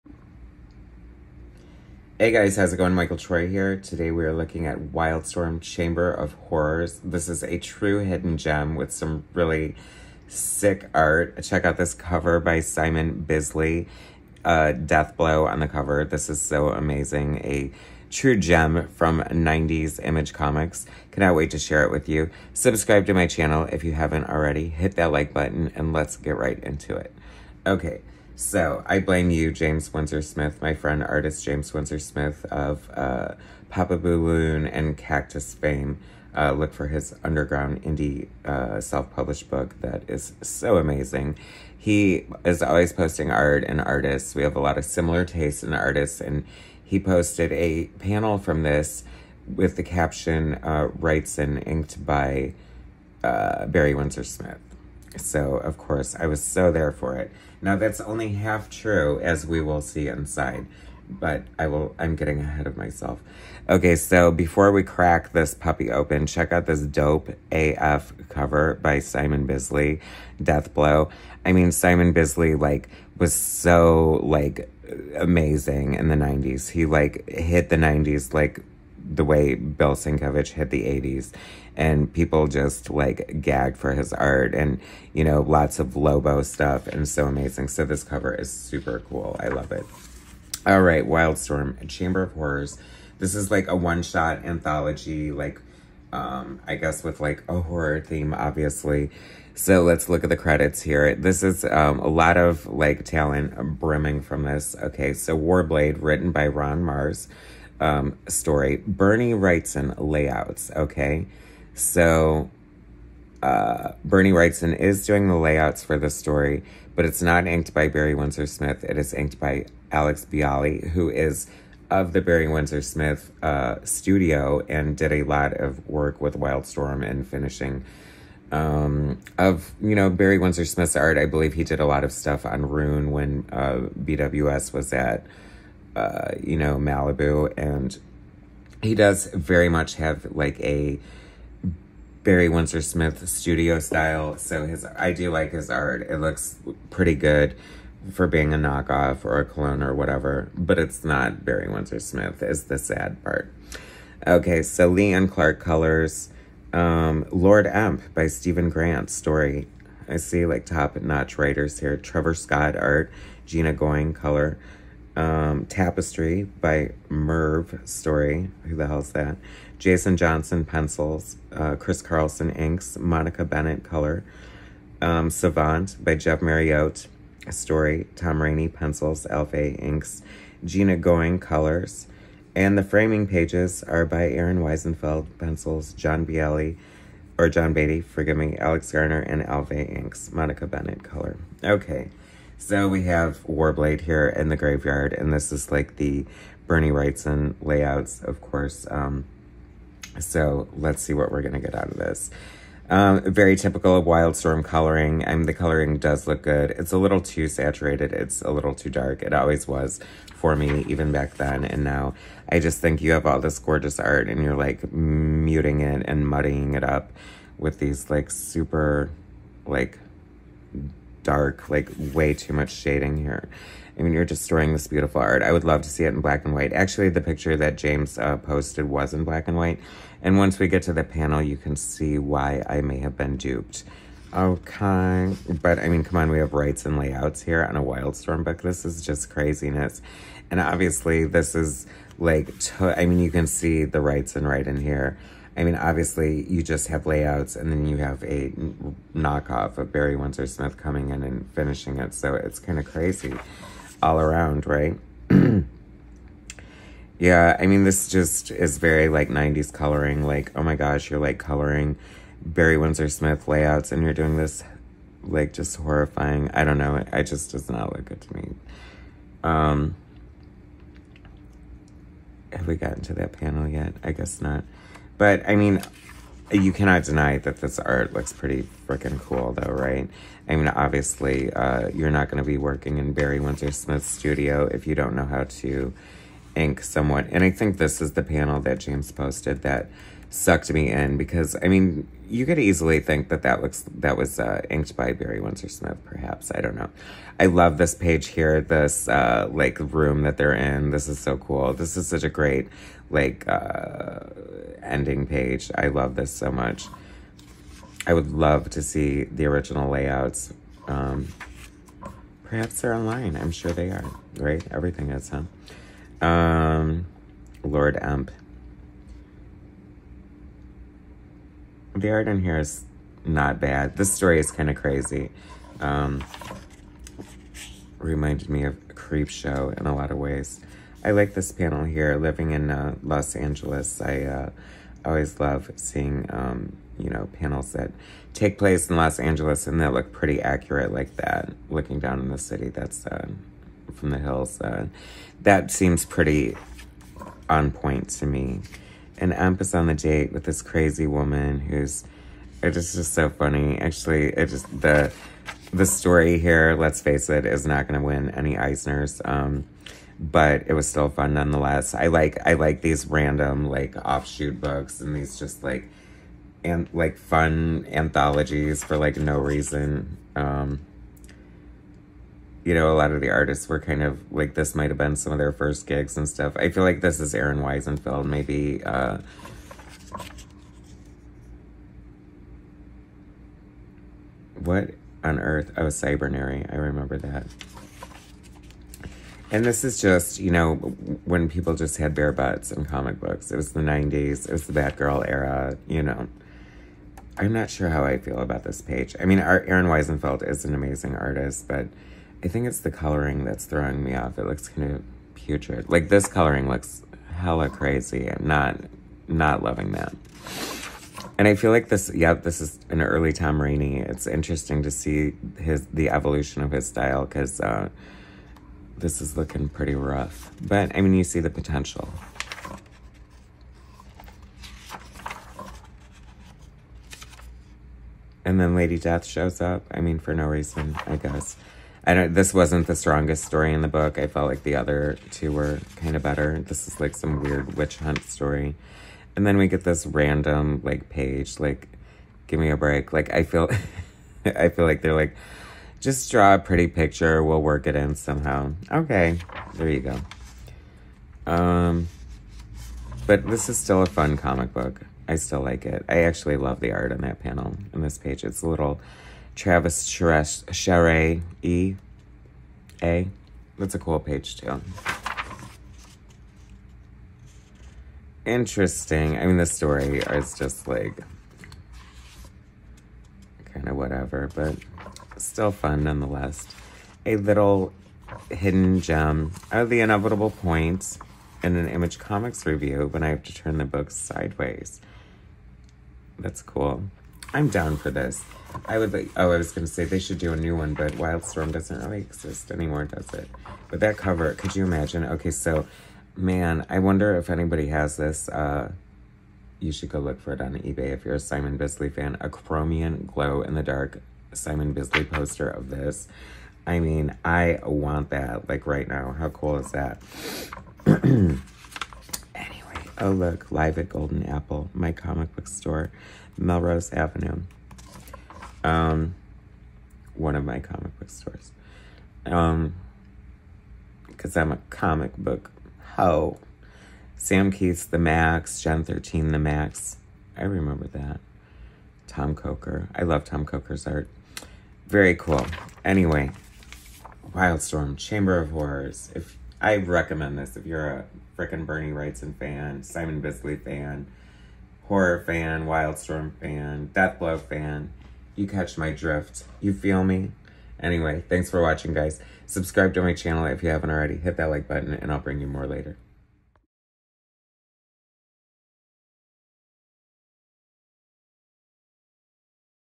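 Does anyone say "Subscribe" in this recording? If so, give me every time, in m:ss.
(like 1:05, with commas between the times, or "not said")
0:22, 9:12.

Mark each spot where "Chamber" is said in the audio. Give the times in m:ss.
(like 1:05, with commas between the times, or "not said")
0:05, 1:31, 8:58.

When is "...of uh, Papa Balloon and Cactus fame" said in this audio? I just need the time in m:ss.
0:32.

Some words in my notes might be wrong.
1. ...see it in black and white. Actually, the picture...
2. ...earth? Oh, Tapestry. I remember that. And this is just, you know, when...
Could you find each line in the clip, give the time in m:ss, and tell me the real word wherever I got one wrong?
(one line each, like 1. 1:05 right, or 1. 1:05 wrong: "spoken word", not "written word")
1. 3:45 right
2. 6:25 wrong: "Cybernary", not "Tapestry".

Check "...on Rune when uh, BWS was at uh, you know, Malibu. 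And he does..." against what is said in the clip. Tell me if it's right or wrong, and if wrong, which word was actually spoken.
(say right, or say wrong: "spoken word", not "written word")
right.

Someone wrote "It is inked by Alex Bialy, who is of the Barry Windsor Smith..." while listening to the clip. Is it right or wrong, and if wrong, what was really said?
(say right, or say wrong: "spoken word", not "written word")
right.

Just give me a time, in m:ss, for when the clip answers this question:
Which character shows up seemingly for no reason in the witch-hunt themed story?
7:08.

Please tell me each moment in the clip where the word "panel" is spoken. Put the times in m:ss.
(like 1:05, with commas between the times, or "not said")
0:47, 3:51, 4:33, 4:48, 5:31, 5:37, 7:37.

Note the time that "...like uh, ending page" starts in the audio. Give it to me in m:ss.
5:03.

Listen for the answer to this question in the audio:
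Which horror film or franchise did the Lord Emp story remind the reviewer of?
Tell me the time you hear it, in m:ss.
5:28.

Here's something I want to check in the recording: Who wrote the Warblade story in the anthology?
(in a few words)
Ron Marz.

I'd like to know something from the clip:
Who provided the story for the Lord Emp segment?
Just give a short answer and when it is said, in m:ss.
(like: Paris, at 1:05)
Steven Grant, at 2:38.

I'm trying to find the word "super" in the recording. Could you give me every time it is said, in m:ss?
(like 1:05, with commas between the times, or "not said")
1:28, 3:38.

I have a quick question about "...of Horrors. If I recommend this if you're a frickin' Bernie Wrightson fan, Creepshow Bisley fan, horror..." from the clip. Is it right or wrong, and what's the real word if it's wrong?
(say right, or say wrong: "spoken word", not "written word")
wrong: "Simon", not "Creepshow".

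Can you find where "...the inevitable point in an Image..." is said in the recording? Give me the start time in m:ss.
7:59.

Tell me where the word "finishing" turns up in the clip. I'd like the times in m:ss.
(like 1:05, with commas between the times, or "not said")
2:07, 4:11.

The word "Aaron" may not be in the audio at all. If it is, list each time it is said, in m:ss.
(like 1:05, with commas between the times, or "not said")
3:04, 6:17, 6:39.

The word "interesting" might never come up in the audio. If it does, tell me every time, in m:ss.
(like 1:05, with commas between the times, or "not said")
6:54, 7:48.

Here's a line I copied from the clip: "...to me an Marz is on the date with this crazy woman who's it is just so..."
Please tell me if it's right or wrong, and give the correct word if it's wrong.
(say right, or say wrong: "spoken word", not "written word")
wrong: "Emp", not "Marz".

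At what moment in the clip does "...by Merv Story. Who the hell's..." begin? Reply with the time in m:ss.
2:46.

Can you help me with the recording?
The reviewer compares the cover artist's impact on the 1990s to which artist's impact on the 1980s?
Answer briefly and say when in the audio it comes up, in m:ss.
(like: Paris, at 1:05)
Bill Sienkiewicz, at 1:19.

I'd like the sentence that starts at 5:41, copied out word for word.
Looking down in the city, that's uh, from the hills.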